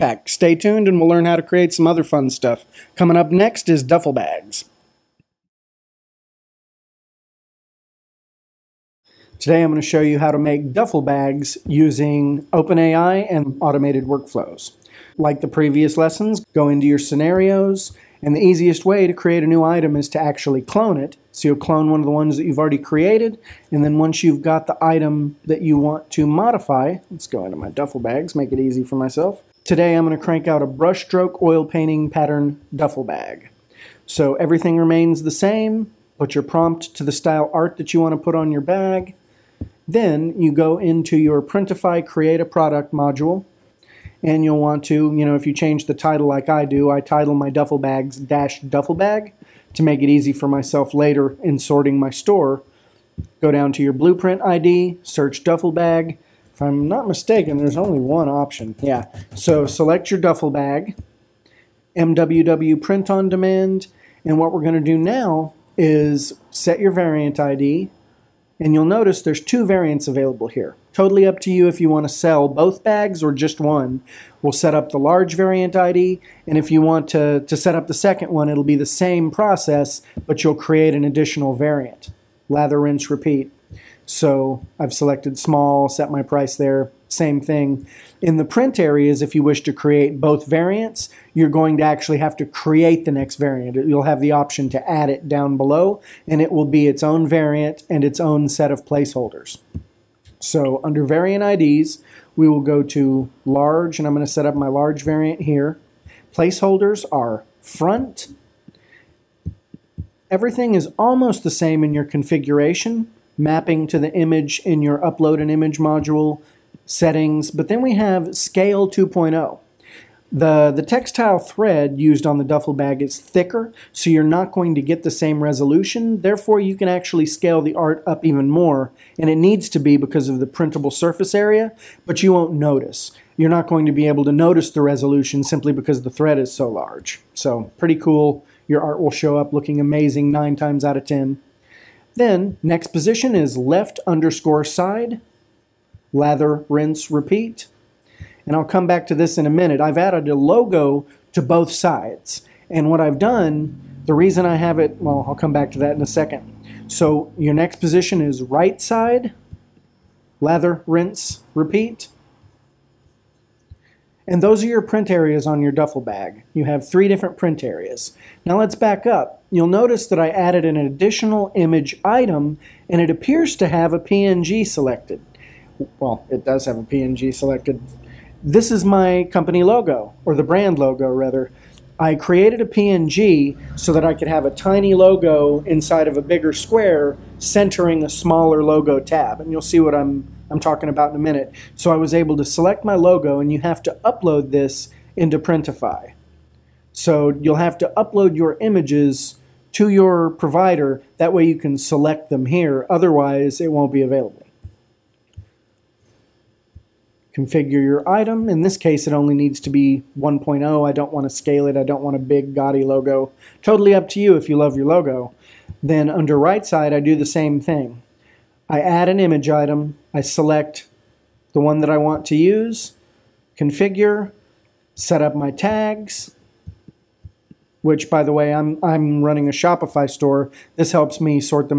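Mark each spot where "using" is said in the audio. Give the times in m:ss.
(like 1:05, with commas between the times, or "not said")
0:11.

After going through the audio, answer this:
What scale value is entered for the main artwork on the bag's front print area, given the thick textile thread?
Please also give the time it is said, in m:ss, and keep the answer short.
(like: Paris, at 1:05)
2.0, at 1:58.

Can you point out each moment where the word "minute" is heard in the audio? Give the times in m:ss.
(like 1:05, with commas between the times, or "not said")
2:29, 3:11.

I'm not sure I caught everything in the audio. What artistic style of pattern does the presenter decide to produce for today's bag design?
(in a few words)
Brushstroke oil painting.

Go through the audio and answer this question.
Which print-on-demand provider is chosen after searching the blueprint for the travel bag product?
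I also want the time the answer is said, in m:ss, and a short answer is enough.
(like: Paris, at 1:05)
MWW, at 1:01.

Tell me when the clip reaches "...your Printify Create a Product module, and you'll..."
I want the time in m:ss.
0:41.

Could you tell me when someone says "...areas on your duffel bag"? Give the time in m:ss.
2:45.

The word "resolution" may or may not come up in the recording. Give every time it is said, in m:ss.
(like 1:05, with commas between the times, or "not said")
2:05, 2:14.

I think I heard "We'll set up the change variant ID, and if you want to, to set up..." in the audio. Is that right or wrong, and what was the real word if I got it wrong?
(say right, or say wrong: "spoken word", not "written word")
wrong: "large", not "change".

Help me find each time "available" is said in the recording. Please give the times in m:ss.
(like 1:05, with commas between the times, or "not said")
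1:10, 3:24.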